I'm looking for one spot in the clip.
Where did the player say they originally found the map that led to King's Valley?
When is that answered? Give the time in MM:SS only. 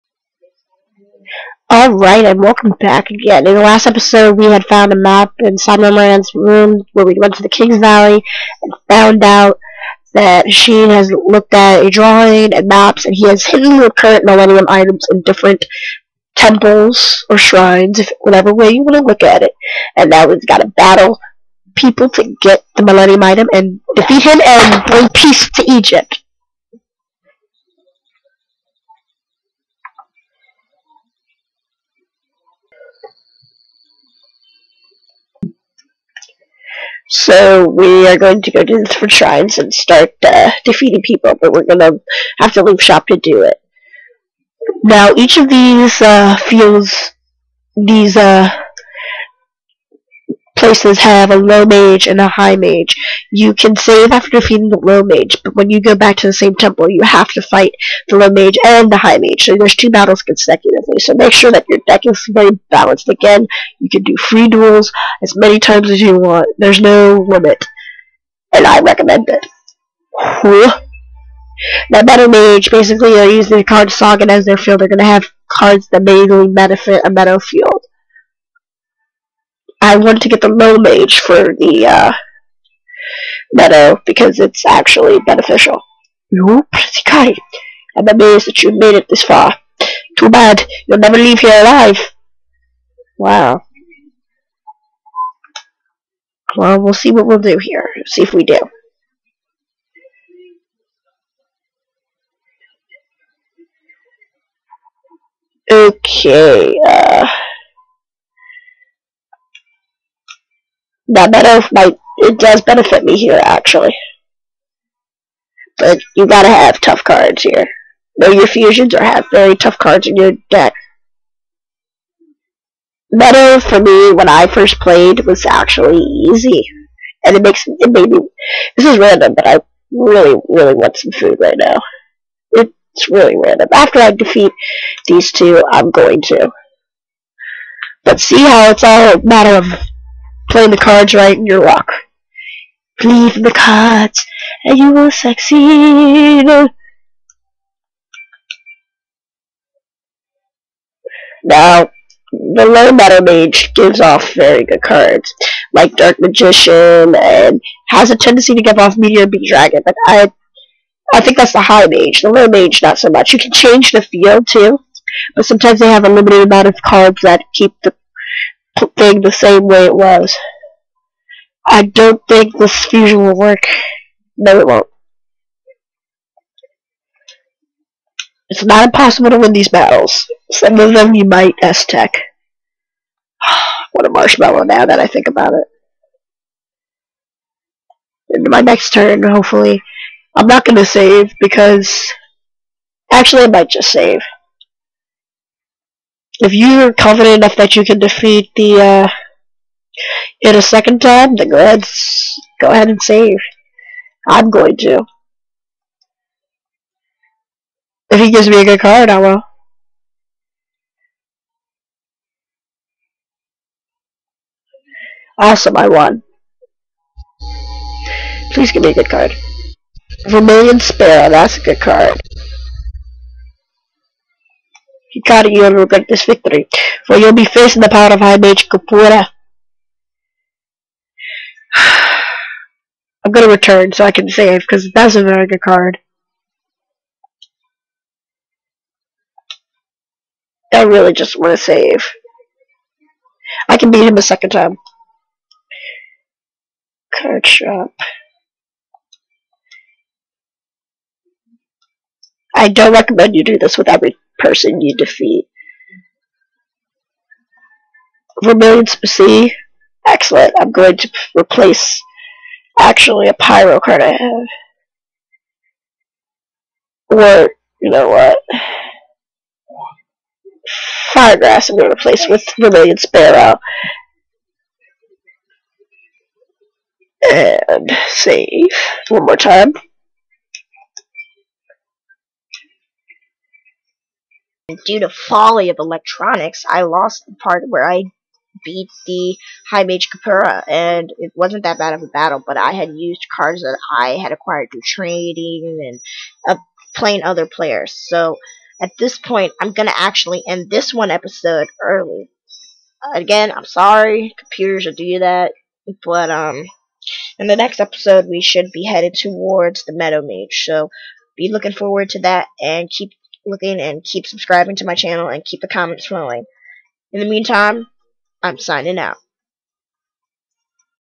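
00:05.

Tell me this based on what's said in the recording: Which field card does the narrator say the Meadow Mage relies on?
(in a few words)
Sogen.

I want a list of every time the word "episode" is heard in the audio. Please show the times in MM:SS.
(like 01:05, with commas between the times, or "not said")
00:03, 05:01, 05:07.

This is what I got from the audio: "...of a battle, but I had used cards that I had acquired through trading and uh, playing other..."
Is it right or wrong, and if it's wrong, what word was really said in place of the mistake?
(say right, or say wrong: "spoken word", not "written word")
right.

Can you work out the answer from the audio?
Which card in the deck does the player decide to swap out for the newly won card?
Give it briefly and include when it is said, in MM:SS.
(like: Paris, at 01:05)
Firegrass, at 04:31.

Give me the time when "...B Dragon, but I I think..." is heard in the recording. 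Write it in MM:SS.
02:39.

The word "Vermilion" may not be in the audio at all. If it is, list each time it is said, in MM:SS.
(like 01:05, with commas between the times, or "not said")
03:40, 04:18, 04:32.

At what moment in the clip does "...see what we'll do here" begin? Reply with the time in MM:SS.
01:36.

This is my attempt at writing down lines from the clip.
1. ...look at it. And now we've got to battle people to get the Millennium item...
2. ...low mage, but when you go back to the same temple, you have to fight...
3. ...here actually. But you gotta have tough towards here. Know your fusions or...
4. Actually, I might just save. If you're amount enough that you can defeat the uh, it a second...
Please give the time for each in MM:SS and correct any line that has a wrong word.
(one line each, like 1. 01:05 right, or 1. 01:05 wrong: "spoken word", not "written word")
1. 00:19 right
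2. 00:54 right
3. 01:53 wrong: "cards", not "towards"
4. 03:13 wrong: "confident", not "amount".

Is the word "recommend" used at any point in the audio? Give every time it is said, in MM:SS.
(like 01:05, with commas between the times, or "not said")
01:08, 04:12.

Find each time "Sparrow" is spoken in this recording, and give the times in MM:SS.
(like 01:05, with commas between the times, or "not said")
03:40, 04:32.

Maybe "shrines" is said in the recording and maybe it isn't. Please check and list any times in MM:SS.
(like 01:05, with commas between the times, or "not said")
00:17, 00:39.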